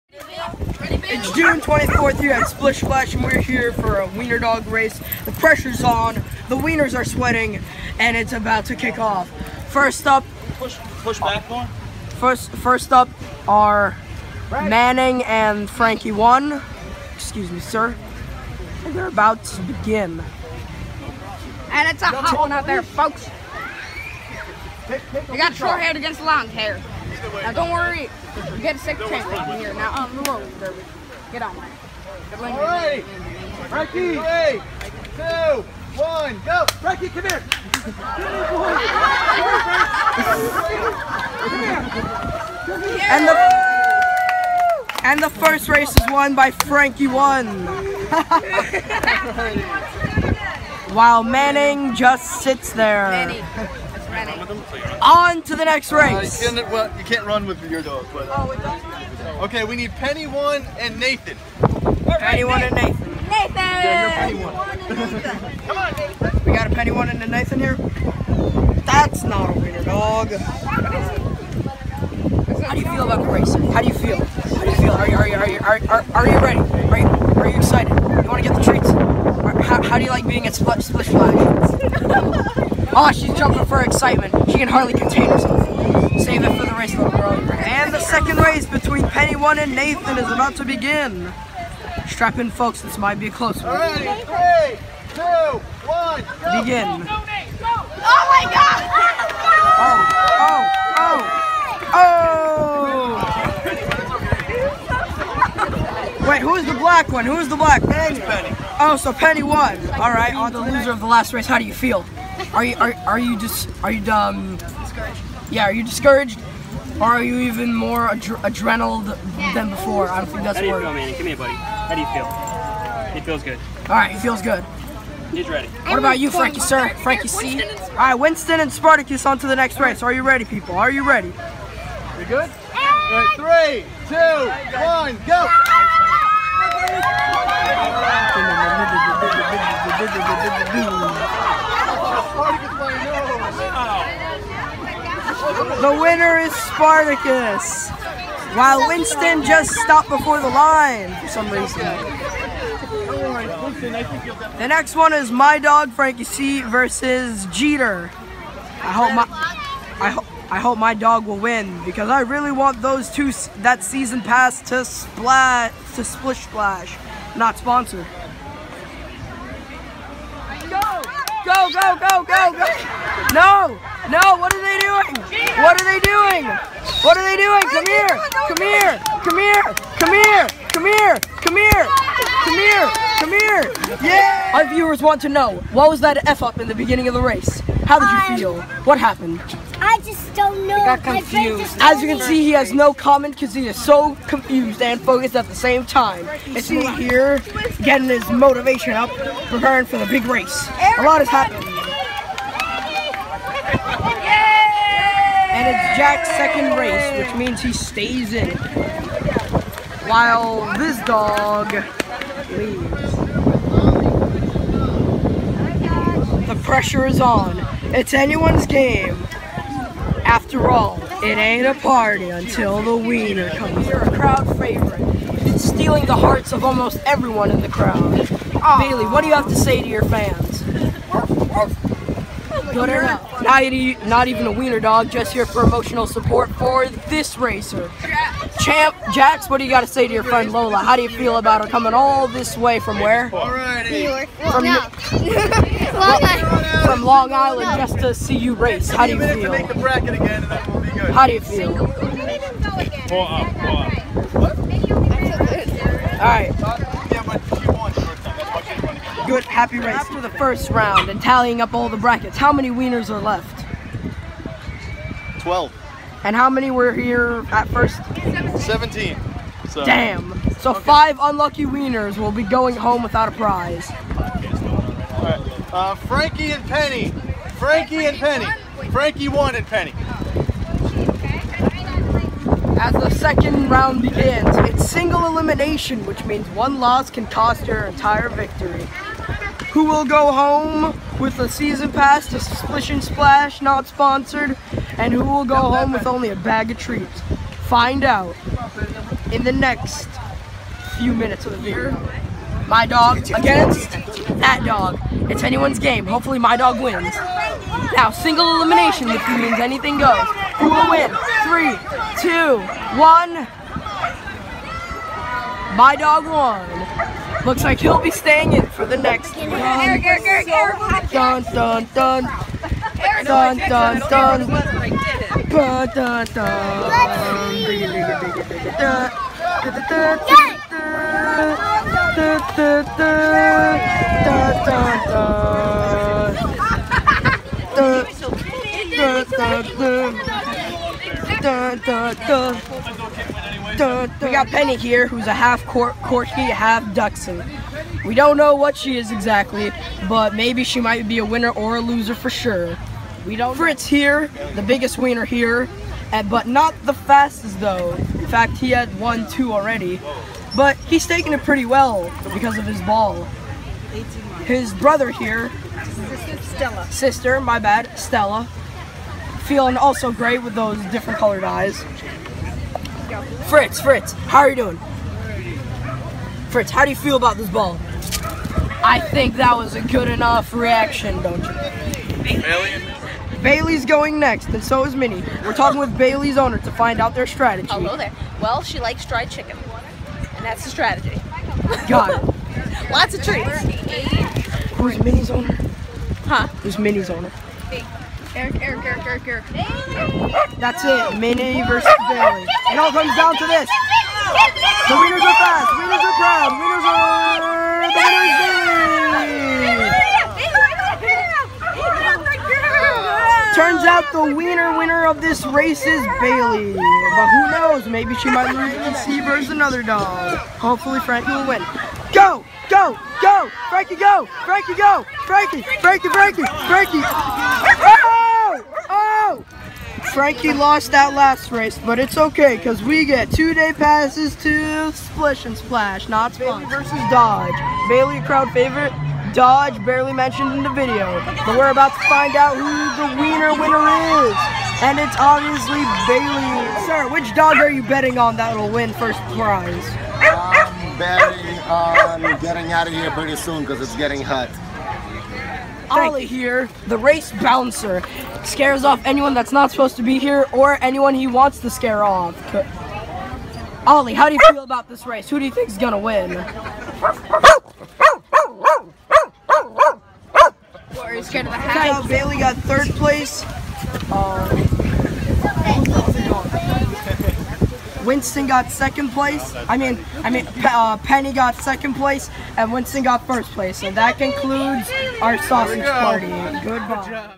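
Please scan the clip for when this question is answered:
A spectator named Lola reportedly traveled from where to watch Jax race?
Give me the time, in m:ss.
4:07.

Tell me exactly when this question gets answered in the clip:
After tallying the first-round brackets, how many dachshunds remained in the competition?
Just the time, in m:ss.
4:25.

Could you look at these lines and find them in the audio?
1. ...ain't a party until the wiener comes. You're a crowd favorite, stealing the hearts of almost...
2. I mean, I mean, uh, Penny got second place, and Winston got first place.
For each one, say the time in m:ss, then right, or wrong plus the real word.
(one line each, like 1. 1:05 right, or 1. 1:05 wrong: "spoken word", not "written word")
1. 3:41 right
2. 7:59 right.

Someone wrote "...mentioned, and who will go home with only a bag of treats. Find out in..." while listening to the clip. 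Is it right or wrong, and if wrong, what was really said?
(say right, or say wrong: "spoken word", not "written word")
wrong: "sponsored", not "mentioned".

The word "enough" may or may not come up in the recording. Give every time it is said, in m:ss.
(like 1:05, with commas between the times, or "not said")
6:20.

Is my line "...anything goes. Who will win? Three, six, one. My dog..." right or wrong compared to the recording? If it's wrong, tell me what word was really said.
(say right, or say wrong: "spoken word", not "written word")
wrong: "two", not "six".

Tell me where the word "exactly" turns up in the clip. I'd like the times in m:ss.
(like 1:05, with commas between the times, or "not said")
5:49.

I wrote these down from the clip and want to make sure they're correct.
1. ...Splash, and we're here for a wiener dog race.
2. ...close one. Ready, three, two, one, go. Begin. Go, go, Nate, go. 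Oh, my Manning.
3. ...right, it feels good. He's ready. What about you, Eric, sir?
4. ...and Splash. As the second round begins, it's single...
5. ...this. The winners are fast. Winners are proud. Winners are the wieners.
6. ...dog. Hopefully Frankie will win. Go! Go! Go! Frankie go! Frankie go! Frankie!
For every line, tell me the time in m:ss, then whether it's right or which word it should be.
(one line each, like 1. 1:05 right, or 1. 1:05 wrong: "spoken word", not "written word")
1. 0:02 right
2. 1:33 wrong: "God", not "Manning"
3. 2:03 wrong: "Frankie", not "Eric"
4. 4:39 wrong: "Penny", not "Splash"
5. 6:43 wrong: "winners", not "wieners"
6. 6:59 right.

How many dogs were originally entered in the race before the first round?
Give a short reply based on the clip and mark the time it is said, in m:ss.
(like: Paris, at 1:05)
17, at 4:28.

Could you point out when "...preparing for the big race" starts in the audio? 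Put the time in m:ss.
3:19.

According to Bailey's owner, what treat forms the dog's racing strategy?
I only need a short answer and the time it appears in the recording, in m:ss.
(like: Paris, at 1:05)
dried chicken, at 6:29.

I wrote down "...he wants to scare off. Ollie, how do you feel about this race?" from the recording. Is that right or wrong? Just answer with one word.
right.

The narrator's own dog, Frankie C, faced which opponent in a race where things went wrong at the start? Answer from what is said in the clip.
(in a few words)
Jeter.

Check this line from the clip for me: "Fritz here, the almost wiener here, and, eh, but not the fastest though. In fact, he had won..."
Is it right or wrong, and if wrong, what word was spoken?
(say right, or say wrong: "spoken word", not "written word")
wrong: "biggest", not "almost".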